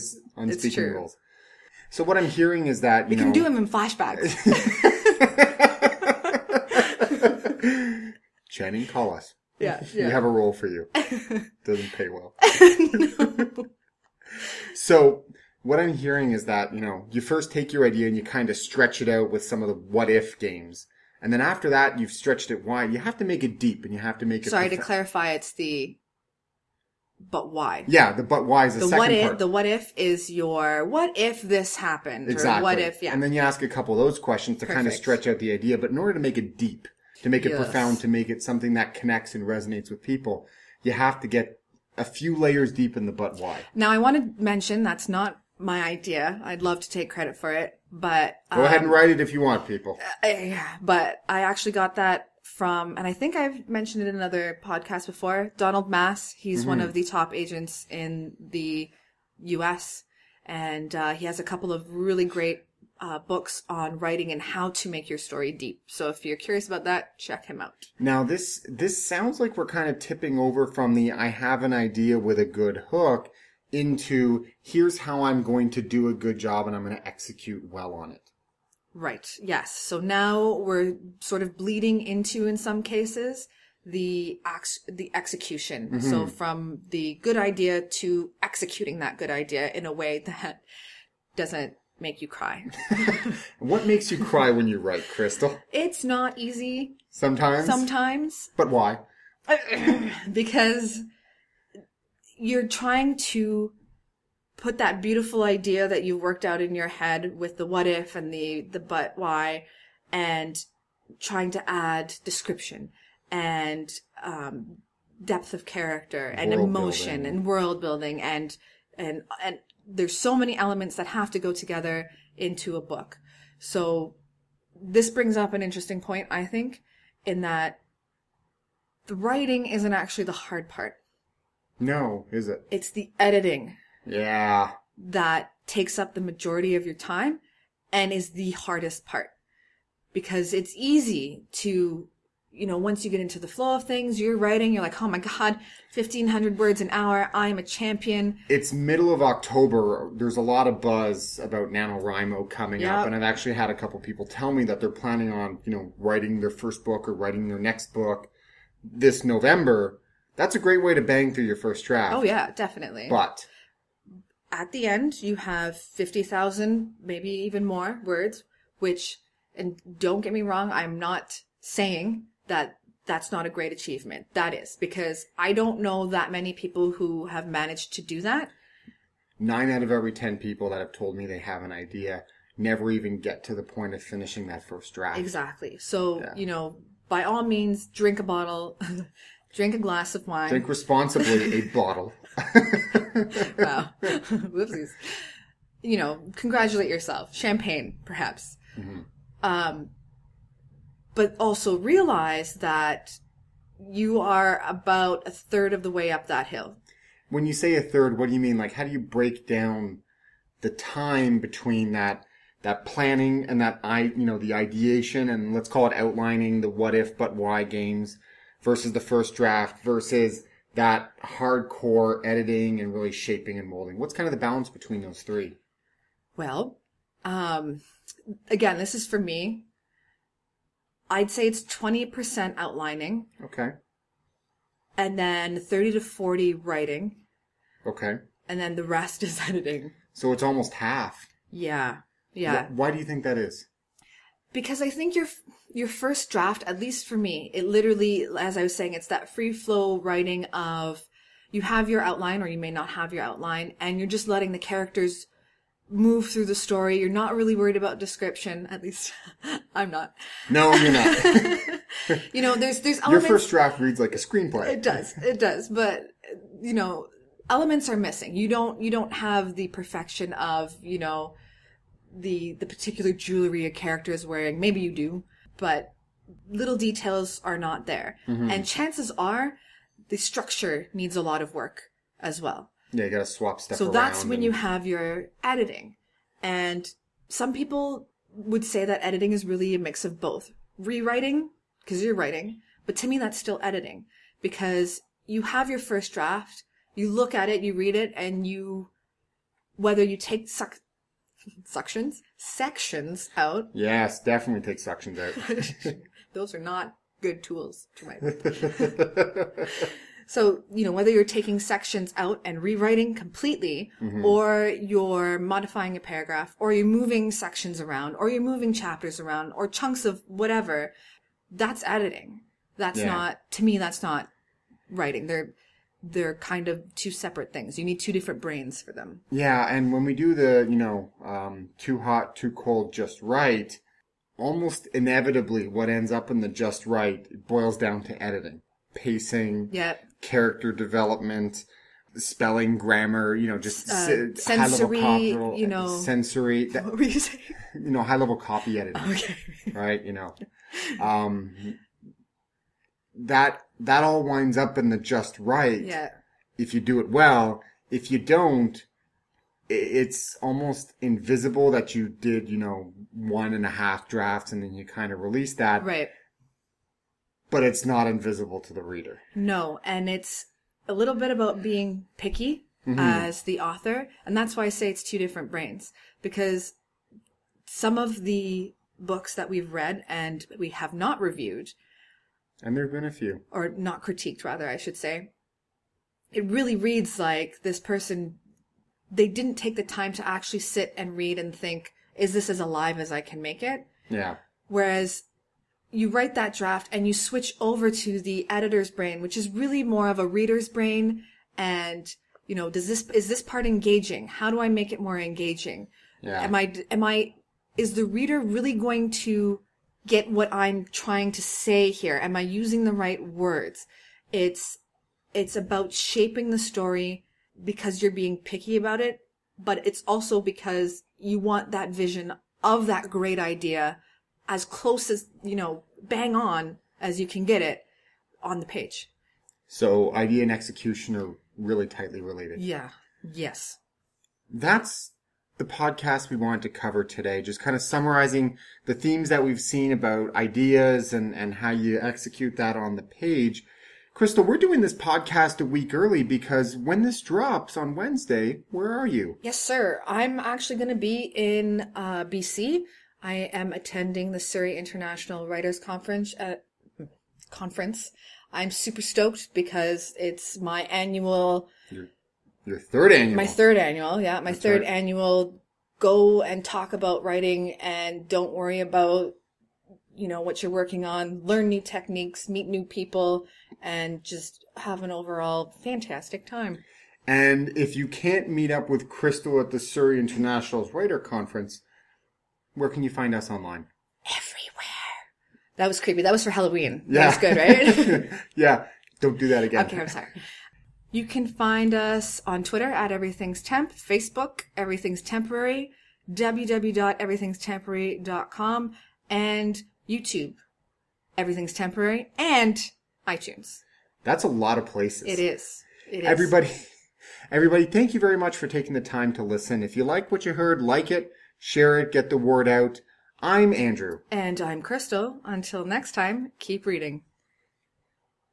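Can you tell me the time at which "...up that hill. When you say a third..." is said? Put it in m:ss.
3:26.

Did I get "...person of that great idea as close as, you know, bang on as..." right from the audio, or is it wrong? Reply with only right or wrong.
wrong.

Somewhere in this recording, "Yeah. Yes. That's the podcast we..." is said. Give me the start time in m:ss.
7:12.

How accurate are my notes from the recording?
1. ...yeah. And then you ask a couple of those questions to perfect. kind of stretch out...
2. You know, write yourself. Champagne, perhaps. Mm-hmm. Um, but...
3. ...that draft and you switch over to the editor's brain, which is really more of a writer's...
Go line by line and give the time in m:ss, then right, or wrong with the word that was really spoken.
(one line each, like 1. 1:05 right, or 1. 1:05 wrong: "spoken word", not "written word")
1. 0:33 right
2. 3:15 wrong: "congratulate", not "write"
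3. 6:36 wrong: "reader", not "writer".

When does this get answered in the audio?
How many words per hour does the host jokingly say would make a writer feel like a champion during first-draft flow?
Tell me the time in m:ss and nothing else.
2:25.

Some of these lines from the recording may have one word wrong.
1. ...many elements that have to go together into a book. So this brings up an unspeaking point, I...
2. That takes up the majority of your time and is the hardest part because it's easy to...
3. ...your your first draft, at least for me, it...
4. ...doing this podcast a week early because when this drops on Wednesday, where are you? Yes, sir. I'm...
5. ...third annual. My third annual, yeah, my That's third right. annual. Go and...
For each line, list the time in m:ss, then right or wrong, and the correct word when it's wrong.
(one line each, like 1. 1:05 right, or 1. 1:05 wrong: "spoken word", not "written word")
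1. 2:00 wrong: "interesting", not "unspeaking"
2. 2:14 right
3. 4:05 right
4. 7:24 right
5. 7:42 right.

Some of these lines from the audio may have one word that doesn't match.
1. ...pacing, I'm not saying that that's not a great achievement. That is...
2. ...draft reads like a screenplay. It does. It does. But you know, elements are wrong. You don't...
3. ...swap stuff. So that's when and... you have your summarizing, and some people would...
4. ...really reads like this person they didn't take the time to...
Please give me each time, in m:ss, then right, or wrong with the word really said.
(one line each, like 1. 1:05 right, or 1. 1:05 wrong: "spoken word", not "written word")
1. 2:50 wrong: "wrong", not "pacing"
2. 4:23 wrong: "missing", not "wrong"
3. 4:43 wrong: "editing", not "summarizing"
4. 6:26 right.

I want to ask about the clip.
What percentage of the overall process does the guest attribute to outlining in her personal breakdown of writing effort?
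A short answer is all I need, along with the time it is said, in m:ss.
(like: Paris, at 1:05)
20%, at 3:51.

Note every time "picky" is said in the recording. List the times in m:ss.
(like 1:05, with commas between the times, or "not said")
6:12, 6:58.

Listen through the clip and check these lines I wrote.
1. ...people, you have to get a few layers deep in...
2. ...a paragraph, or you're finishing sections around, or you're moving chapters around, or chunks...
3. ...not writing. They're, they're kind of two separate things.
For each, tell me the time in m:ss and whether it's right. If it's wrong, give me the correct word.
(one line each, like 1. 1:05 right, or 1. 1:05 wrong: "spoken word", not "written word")
1. 0:40 right
2. 5:15 wrong: "moving", not "finishing"
3. 5:24 right.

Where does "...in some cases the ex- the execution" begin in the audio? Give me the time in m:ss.
1:22.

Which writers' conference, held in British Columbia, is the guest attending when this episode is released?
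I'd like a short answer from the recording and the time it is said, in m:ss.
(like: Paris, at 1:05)
Surrey International Writers Conference, at 7:34.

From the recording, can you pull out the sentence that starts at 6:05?
Right but it's not invisible to the reader.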